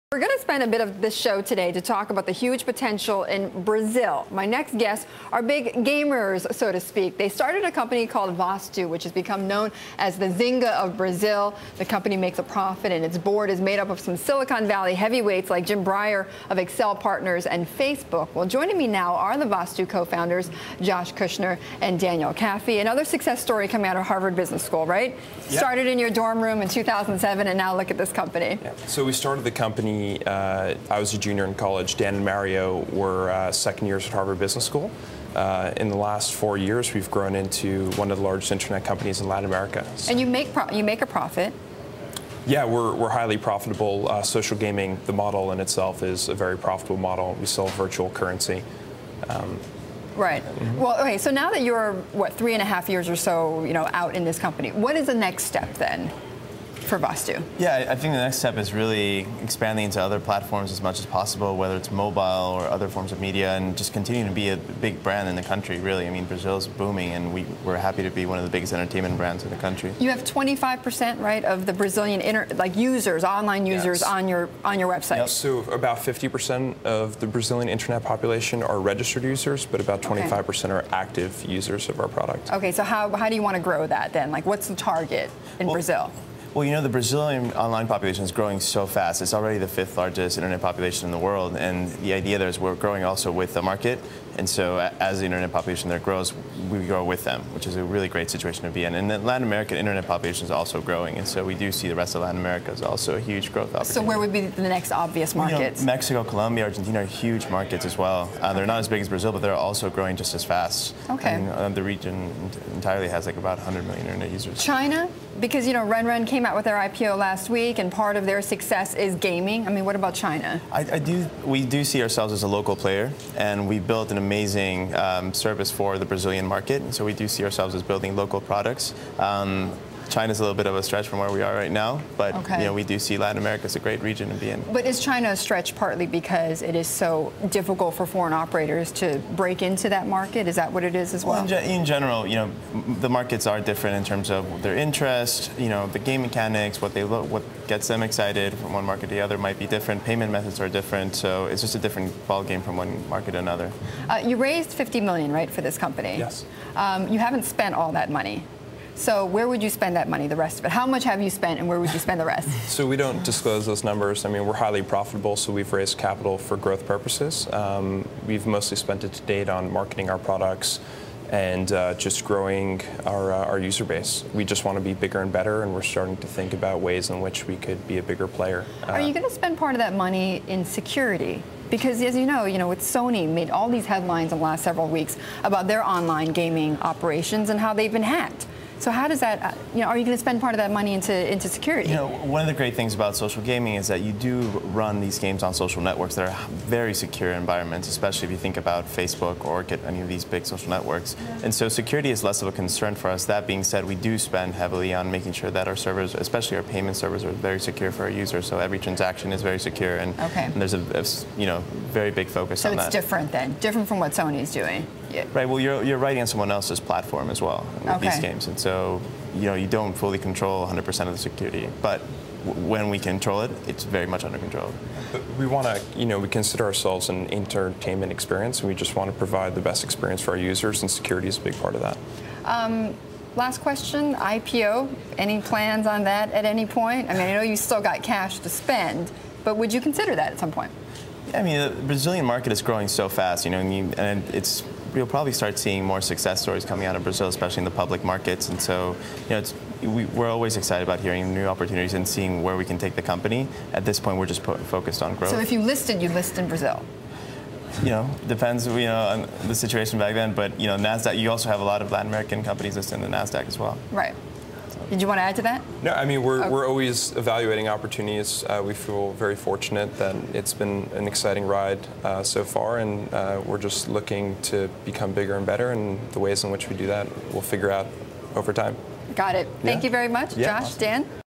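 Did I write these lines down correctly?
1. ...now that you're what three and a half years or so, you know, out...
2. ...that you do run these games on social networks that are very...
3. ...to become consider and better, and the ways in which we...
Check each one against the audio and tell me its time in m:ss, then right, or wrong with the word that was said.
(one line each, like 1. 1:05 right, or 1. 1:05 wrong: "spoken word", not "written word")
1. 0:51 right
2. 3:13 right
3. 4:34 wrong: "bigger", not "consider".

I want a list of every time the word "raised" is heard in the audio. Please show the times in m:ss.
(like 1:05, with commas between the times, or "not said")
2:34, 2:45.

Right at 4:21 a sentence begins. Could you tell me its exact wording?
You also have a lot of Latin American companies listed in the Nasdaq as well.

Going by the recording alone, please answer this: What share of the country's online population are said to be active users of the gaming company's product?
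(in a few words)
25%.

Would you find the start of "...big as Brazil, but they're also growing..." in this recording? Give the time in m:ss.
1:48.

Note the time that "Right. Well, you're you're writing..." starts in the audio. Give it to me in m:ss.
3:35.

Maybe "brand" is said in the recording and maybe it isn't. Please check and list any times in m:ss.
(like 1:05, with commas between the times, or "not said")
1:05, 1:09.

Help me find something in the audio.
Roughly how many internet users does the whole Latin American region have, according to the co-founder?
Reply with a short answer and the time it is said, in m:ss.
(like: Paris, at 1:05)
100 million, at 1:53.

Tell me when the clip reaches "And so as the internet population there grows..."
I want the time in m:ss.
1:34.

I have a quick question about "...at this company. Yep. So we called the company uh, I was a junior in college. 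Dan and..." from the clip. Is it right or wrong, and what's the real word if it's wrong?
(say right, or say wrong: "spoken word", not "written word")
wrong: "started", not "called".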